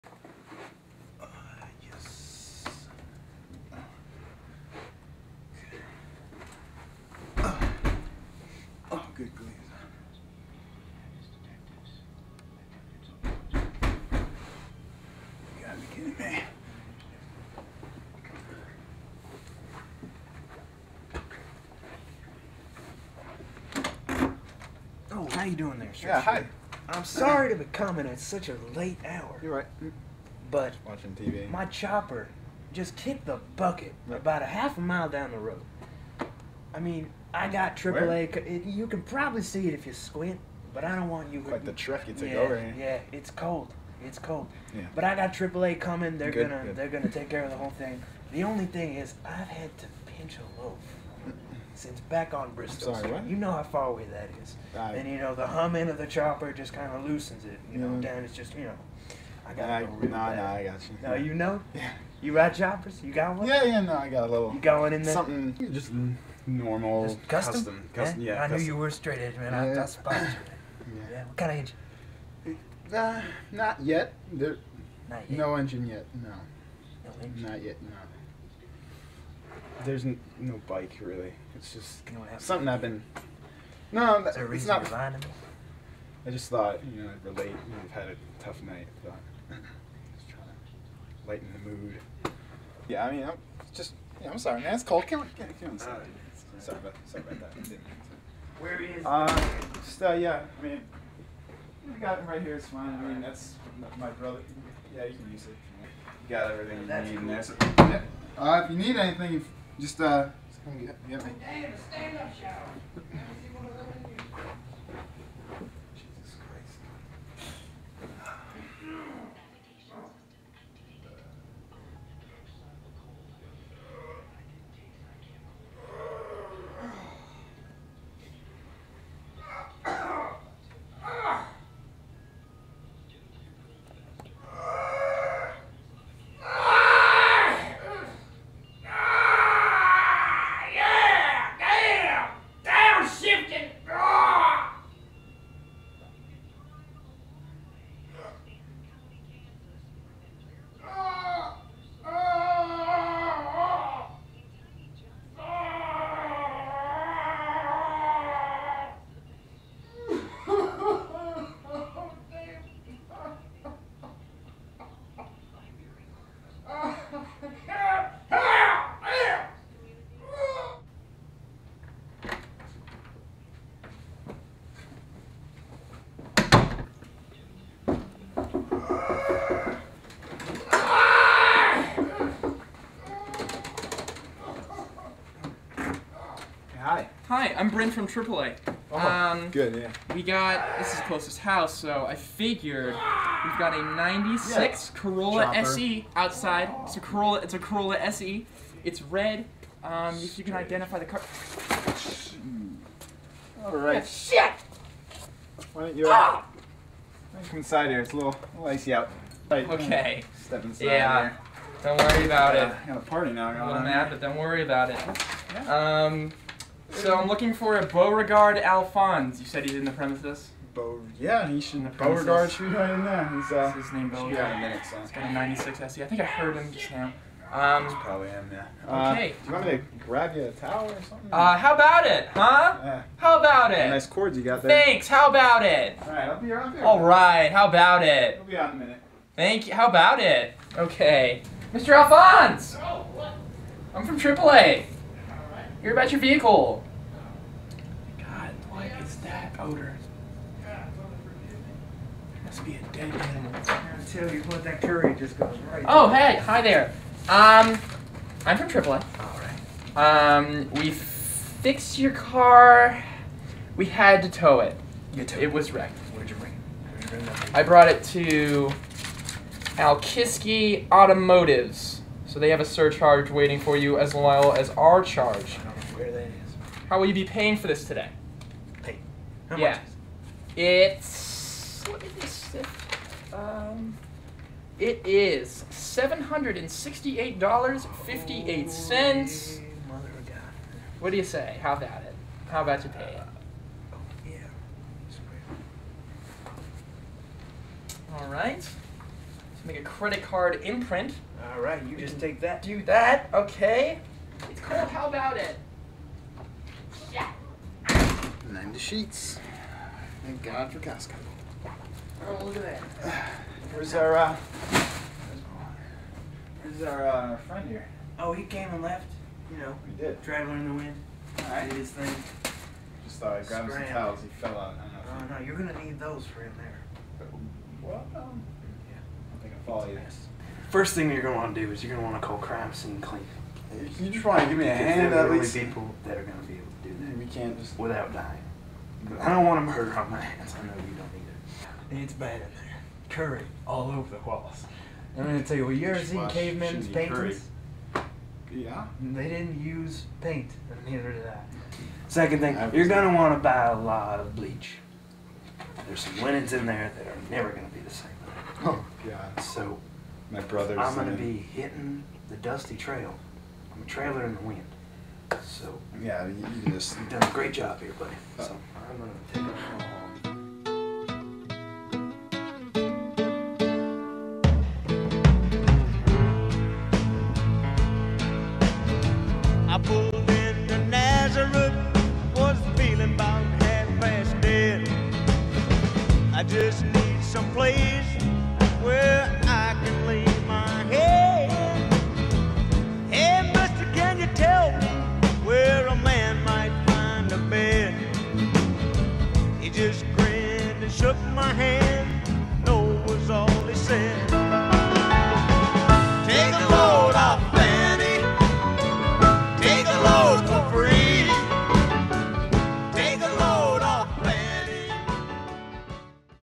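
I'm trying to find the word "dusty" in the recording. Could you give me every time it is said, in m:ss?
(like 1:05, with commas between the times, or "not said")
6:02.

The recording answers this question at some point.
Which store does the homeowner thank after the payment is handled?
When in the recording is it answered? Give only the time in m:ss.
5:10.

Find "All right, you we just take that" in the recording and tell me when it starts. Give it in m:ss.
5:01.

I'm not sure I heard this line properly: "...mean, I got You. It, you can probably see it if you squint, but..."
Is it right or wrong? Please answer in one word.
wrong.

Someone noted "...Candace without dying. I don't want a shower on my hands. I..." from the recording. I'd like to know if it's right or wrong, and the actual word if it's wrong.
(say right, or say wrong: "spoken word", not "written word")
wrong: "murder", not "shower".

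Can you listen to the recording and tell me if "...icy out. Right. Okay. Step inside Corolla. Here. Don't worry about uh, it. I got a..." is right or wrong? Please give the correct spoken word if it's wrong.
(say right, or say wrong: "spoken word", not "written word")
wrong: "Yeah", not "Corolla".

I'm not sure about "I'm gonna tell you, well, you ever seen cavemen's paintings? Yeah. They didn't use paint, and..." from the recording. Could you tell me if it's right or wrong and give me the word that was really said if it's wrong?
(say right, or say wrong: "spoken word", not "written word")
right.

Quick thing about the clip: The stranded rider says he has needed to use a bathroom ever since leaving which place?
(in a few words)
Bristol.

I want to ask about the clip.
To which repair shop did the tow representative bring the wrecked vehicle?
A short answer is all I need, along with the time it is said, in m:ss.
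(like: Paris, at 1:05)
Alkiski Automotives, at 4:29.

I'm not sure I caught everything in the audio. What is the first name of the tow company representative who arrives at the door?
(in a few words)
Bryn.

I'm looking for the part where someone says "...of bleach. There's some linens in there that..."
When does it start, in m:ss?
5:54.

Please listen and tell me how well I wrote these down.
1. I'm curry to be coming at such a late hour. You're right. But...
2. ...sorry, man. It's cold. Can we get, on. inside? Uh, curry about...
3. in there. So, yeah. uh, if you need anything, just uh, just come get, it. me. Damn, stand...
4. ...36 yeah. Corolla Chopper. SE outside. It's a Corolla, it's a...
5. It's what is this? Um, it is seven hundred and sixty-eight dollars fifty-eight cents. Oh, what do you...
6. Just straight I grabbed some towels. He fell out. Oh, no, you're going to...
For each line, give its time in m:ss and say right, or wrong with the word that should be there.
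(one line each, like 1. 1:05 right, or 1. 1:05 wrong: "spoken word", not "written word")
1. 0:26 wrong: "sorry", not "curry"
2. 1:34 wrong: "sorry", not "curry"
3. 1:47 right
4. 3:13 wrong: "96", not "36"
5. 4:40 right
6. 5:23 wrong: "thought", not "straight".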